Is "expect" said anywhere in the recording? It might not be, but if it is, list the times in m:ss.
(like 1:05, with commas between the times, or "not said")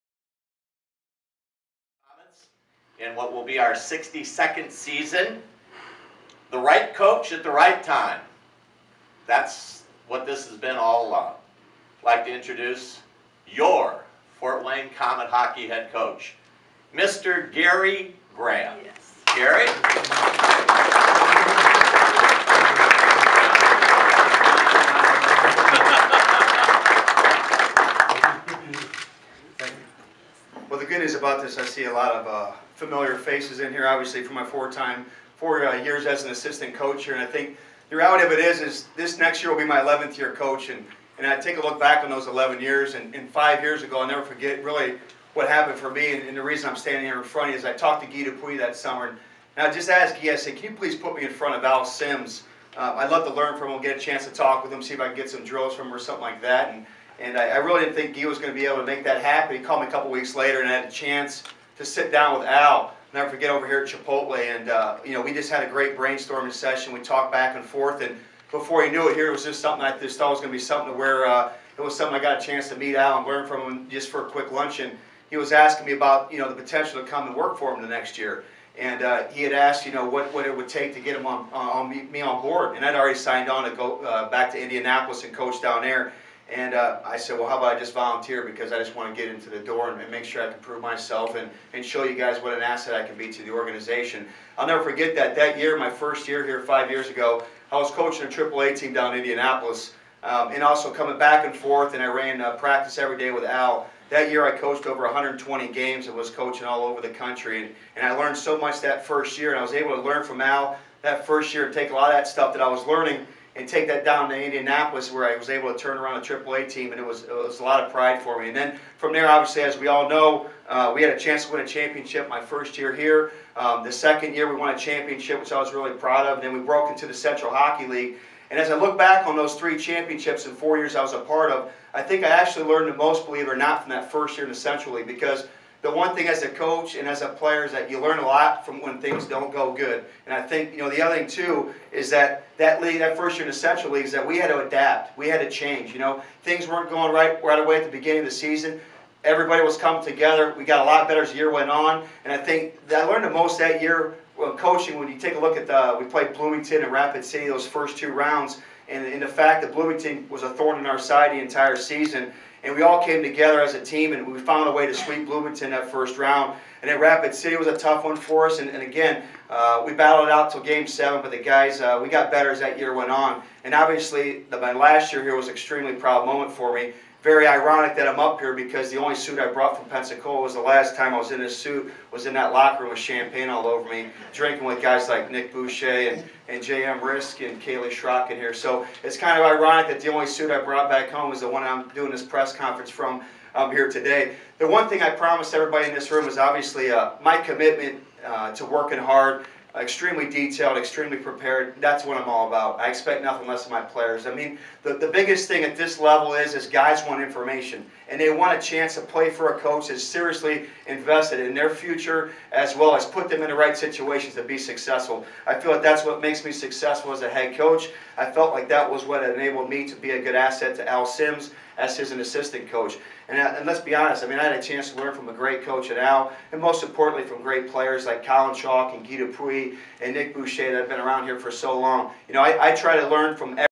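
3:22.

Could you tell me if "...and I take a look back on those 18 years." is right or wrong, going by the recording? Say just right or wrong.
wrong.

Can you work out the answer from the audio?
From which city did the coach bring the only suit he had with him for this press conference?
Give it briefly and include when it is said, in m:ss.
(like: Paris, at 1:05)
Pensacola, at 2:59.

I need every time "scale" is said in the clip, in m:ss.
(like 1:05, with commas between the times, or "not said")
not said.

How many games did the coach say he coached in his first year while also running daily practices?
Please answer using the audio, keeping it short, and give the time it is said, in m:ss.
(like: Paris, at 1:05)
over 120, at 1:44.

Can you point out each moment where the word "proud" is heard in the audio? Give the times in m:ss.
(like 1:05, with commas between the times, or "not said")
2:05, 2:55.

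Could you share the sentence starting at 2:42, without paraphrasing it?
And we all came together as a team, and we found a way to sweep Bloomington that first round.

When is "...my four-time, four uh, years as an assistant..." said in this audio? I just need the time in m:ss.
0:34.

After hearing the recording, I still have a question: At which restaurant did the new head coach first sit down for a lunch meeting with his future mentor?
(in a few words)
Chipotle.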